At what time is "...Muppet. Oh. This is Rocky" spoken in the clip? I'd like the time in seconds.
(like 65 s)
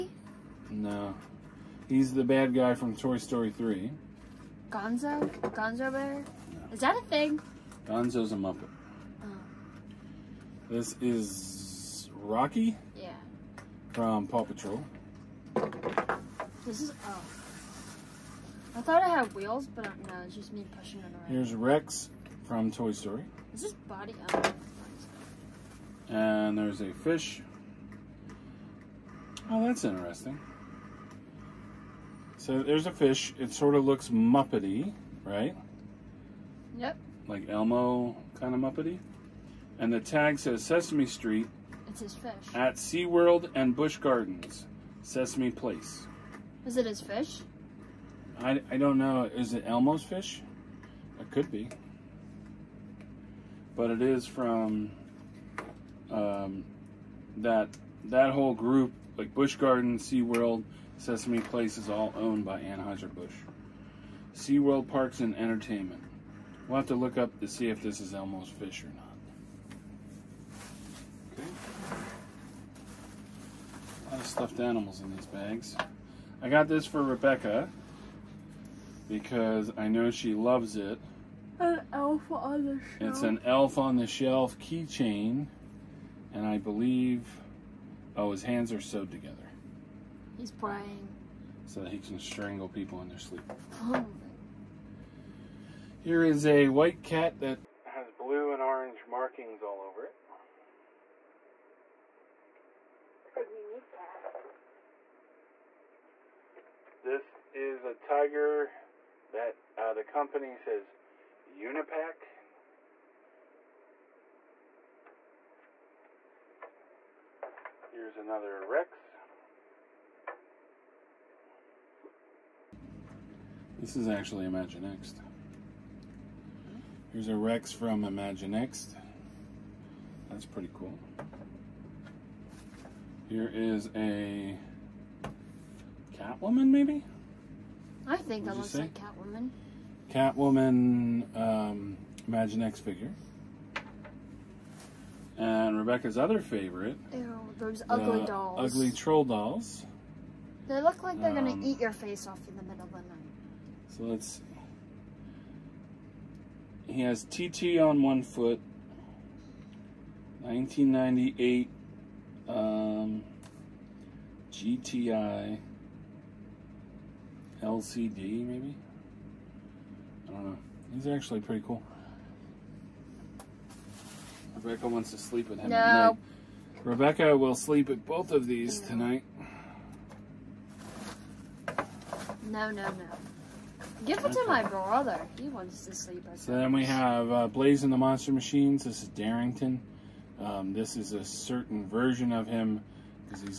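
8 s.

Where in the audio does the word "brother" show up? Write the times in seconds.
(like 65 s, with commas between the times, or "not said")
184 s.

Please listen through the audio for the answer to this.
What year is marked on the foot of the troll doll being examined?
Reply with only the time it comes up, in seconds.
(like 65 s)
160 s.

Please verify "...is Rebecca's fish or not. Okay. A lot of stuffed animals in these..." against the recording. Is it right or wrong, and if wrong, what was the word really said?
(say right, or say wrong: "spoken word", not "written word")
wrong: "Elmo", not "Rebecca".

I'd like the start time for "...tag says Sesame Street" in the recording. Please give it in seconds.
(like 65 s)
39 s.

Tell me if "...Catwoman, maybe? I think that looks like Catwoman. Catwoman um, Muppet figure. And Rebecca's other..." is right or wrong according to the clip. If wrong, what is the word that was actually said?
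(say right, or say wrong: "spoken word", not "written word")
wrong: "Imaginext", not "Muppet".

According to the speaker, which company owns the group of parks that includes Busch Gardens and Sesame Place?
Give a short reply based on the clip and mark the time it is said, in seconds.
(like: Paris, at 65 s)
Anheuser-Busch, at 62 s.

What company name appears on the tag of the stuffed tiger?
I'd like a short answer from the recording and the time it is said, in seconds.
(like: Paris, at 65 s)
Unipak, at 111 s.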